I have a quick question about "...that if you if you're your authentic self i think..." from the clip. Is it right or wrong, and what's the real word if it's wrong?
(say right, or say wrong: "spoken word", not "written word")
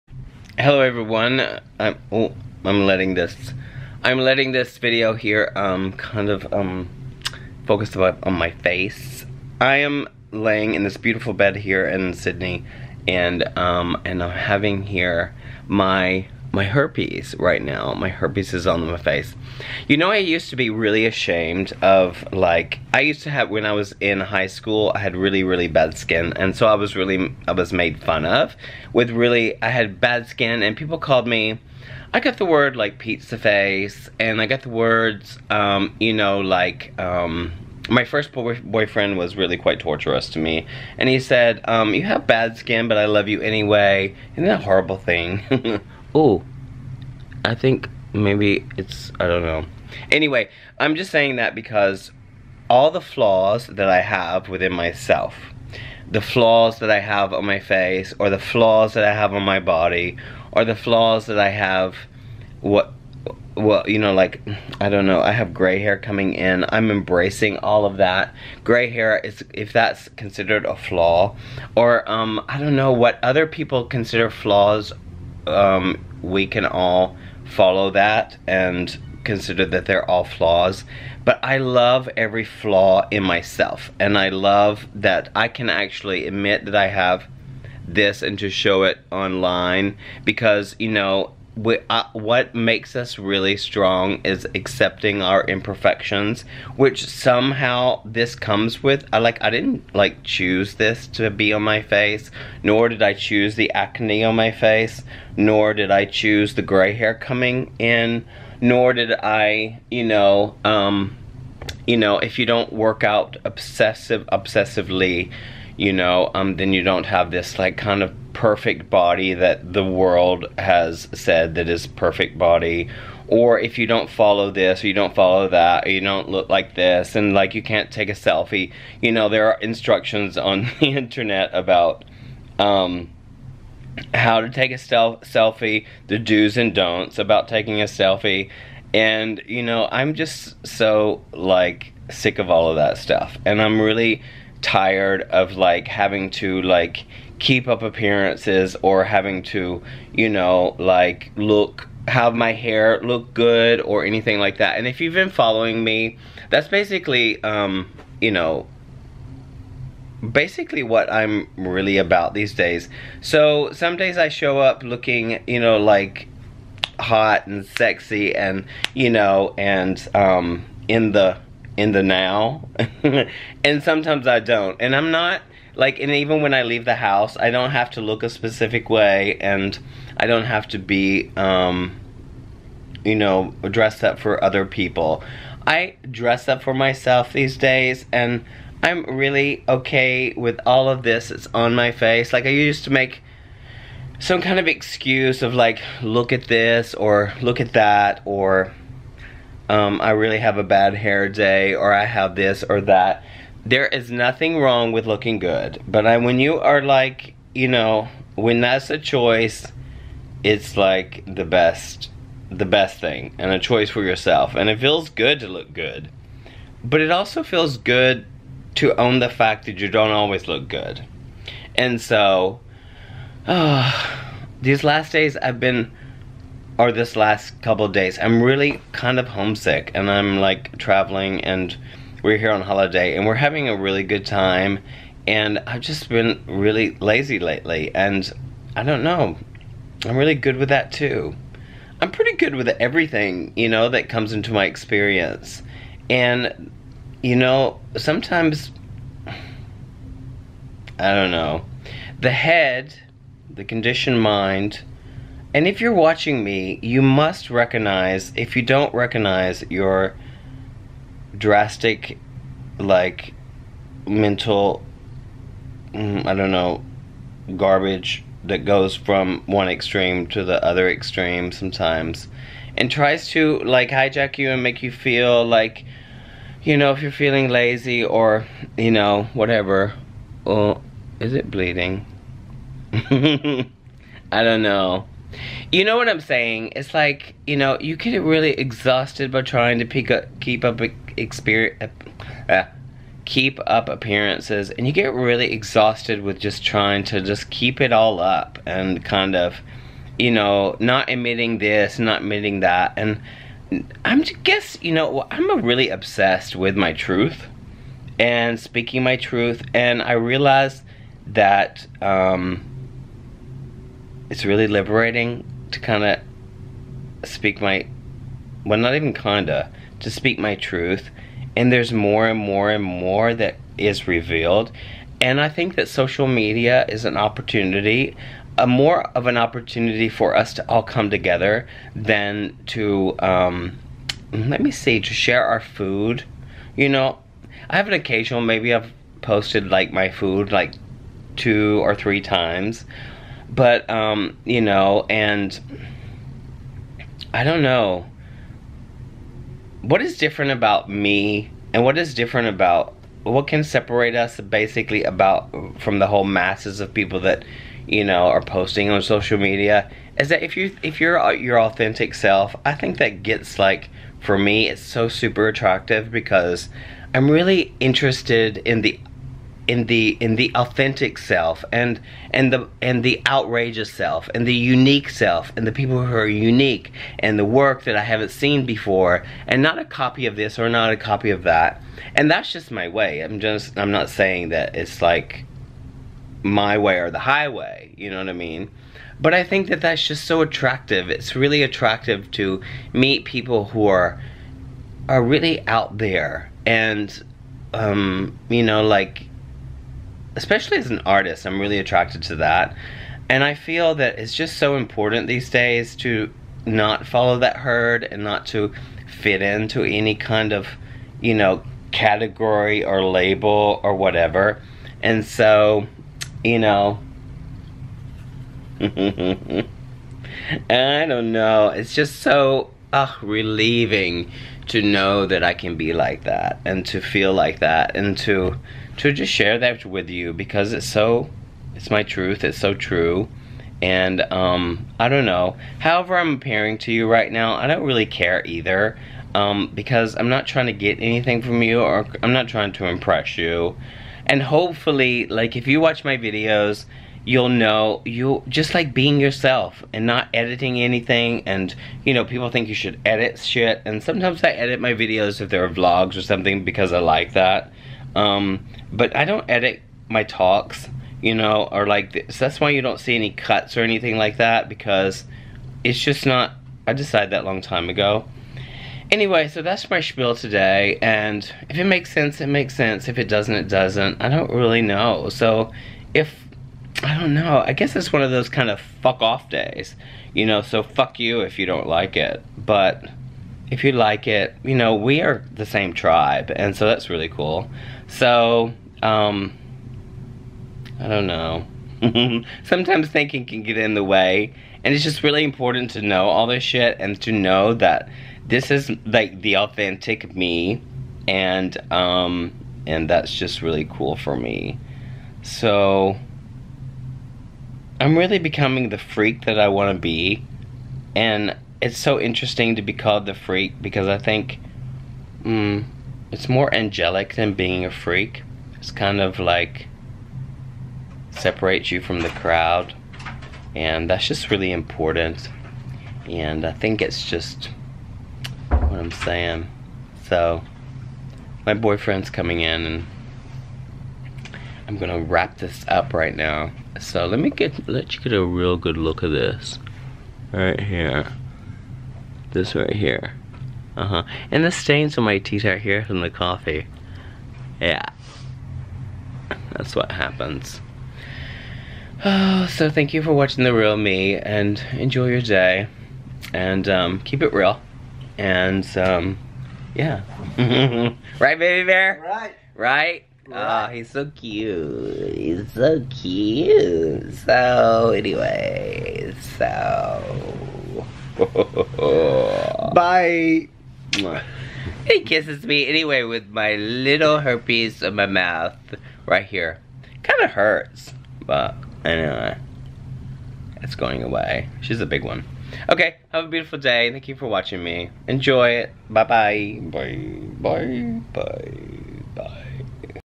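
right.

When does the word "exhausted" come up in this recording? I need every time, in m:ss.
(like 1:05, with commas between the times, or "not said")
4:48, 4:55.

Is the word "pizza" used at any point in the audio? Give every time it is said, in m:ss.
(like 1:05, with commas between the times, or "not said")
0:32.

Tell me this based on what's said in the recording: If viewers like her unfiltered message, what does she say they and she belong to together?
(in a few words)
the same tribe.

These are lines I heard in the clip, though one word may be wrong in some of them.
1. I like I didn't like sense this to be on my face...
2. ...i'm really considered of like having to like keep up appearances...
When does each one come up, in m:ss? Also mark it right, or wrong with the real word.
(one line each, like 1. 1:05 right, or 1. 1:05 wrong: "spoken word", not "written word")
1. 1:39 wrong: "choose", not "sense"
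2. 2:23 wrong: "tired", not "considered".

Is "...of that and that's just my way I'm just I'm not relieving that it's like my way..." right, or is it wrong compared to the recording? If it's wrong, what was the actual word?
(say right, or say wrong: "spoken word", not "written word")
wrong: "saying", not "relieving".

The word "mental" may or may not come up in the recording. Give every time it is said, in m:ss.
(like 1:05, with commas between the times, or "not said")
4:24.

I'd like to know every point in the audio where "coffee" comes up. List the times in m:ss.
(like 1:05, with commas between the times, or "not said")
9:06.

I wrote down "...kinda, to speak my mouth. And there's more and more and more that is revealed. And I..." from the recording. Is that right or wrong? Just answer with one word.
wrong.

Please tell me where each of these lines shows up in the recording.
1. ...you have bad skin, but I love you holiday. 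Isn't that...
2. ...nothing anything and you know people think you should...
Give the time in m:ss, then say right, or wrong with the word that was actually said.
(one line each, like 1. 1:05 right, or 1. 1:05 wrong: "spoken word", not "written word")
1. 0:41 wrong: "anyway", not "holiday"
2. 7:30 wrong: "editing", not "nothing".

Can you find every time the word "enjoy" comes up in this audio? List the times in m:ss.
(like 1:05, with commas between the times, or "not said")
9:14, 9:48.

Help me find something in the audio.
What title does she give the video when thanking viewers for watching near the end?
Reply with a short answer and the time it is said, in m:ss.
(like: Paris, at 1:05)
The Real Me, at 9:13.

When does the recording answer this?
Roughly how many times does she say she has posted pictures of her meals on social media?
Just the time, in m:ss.
5:41.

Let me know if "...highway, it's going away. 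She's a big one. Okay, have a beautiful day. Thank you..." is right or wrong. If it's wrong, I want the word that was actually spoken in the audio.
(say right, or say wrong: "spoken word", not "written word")
wrong: "anyway", not "highway".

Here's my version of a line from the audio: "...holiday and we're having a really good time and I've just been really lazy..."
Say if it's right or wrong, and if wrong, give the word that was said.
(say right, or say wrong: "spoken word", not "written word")
right.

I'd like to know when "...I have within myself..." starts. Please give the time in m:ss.
0:53.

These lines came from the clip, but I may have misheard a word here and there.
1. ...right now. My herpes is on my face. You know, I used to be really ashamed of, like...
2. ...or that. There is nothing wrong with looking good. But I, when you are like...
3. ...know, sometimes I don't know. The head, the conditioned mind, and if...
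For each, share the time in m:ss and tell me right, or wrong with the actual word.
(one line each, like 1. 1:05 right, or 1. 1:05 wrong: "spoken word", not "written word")
1. 0:17 right
2. 3:22 right
3. 4:07 right.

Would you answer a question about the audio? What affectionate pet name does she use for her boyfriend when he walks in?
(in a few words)
baby bear.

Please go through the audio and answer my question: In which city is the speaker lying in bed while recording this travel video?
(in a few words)
Sydney.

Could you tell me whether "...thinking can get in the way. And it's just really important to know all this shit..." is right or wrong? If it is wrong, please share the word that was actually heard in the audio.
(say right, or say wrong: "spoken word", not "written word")
right.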